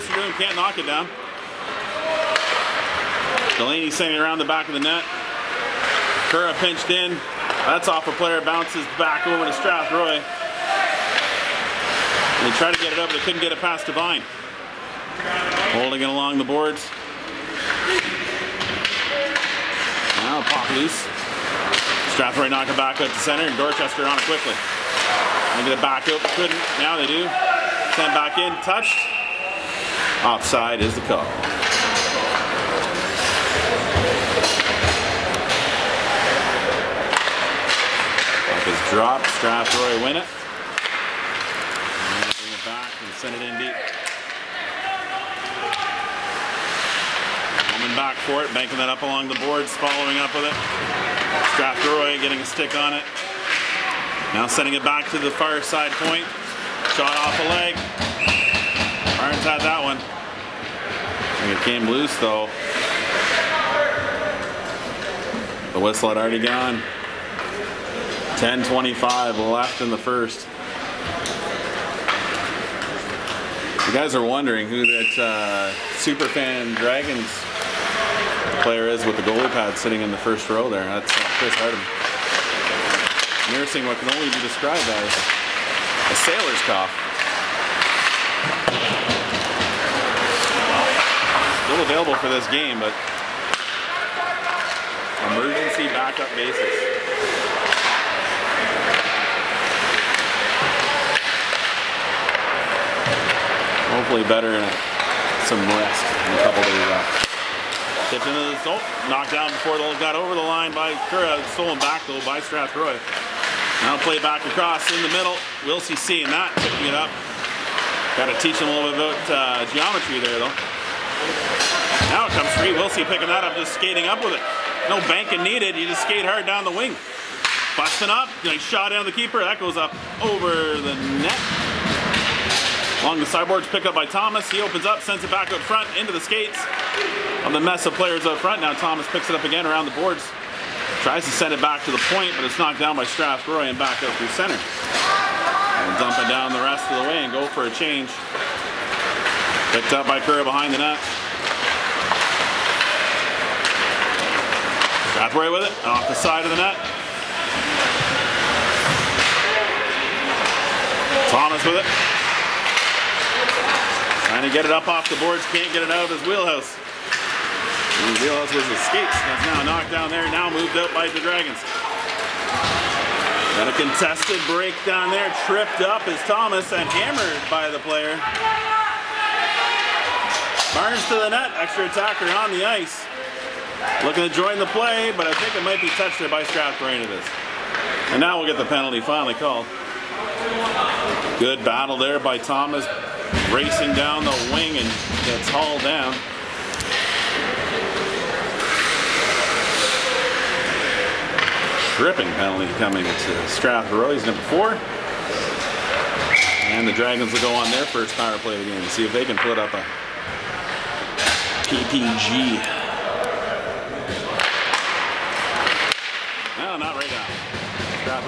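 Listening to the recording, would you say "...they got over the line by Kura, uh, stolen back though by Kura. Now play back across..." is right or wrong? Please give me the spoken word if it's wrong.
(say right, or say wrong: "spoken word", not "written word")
wrong: "Strathroy", not "Kura".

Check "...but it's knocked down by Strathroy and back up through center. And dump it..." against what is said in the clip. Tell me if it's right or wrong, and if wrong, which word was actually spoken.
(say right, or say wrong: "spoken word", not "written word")
right.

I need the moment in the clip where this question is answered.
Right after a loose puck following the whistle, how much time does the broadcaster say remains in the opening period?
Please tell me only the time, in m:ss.
1:08.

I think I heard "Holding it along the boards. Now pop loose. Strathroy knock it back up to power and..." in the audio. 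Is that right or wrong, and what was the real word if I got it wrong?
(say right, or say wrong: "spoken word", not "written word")
wrong: "center", not "power".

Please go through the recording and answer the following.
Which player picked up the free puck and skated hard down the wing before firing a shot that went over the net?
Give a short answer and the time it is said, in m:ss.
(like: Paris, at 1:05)
Wilsey, at 2:02.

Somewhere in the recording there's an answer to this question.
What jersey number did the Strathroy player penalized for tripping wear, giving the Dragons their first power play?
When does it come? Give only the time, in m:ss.
3:24.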